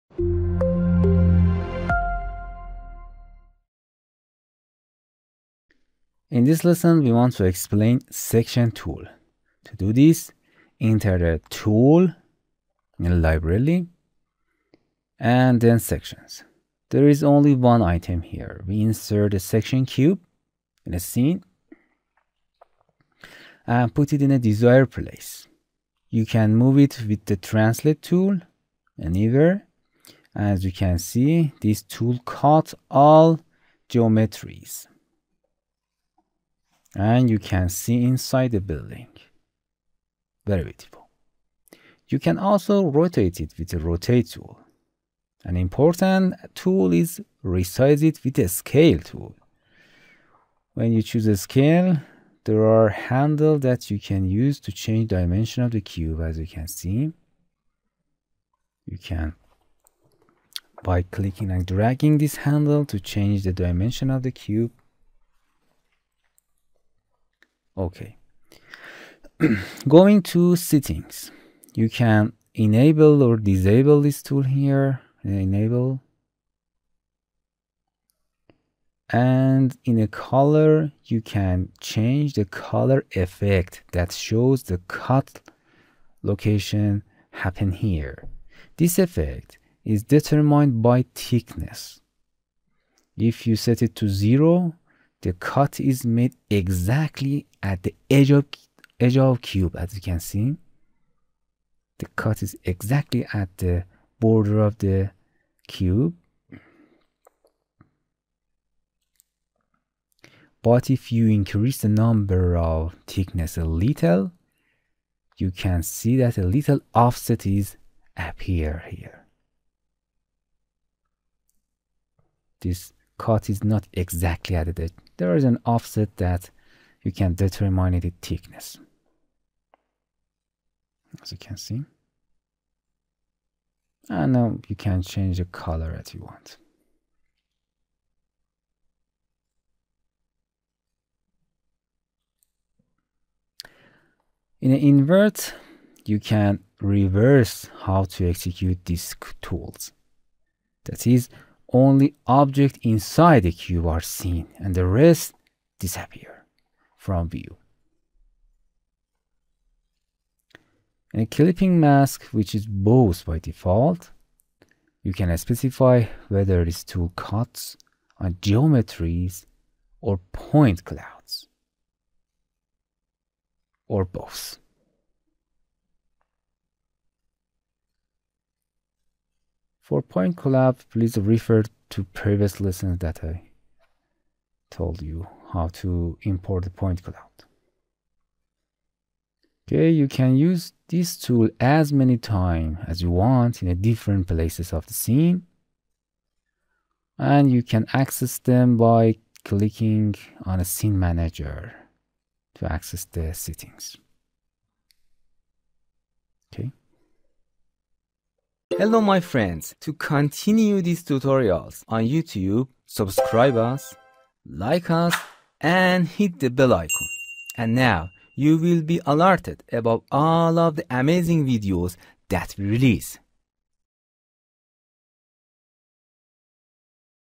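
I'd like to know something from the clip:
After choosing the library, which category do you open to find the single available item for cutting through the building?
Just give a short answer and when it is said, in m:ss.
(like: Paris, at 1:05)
Sections, at 0:15.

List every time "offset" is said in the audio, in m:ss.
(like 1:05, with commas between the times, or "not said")
1:56, 2:05.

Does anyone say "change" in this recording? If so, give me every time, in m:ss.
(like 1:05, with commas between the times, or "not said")
0:54, 1:02, 1:21, 2:15.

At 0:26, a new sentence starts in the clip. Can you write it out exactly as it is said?
You can move it with the translate tool anywhere.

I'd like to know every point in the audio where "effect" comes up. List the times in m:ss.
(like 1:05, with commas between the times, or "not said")
1:23, 1:28.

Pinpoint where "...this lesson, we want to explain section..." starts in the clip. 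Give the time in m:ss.
0:06.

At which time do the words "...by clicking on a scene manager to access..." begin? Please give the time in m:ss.
3:18.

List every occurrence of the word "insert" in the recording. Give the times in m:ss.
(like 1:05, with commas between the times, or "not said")
0:18.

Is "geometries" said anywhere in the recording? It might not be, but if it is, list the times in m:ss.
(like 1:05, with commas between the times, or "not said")
0:33, 2:48.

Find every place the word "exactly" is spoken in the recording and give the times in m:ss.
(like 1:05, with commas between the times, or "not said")
1:36, 1:42, 2:03.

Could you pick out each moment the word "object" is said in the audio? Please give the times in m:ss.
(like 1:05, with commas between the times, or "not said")
2:32.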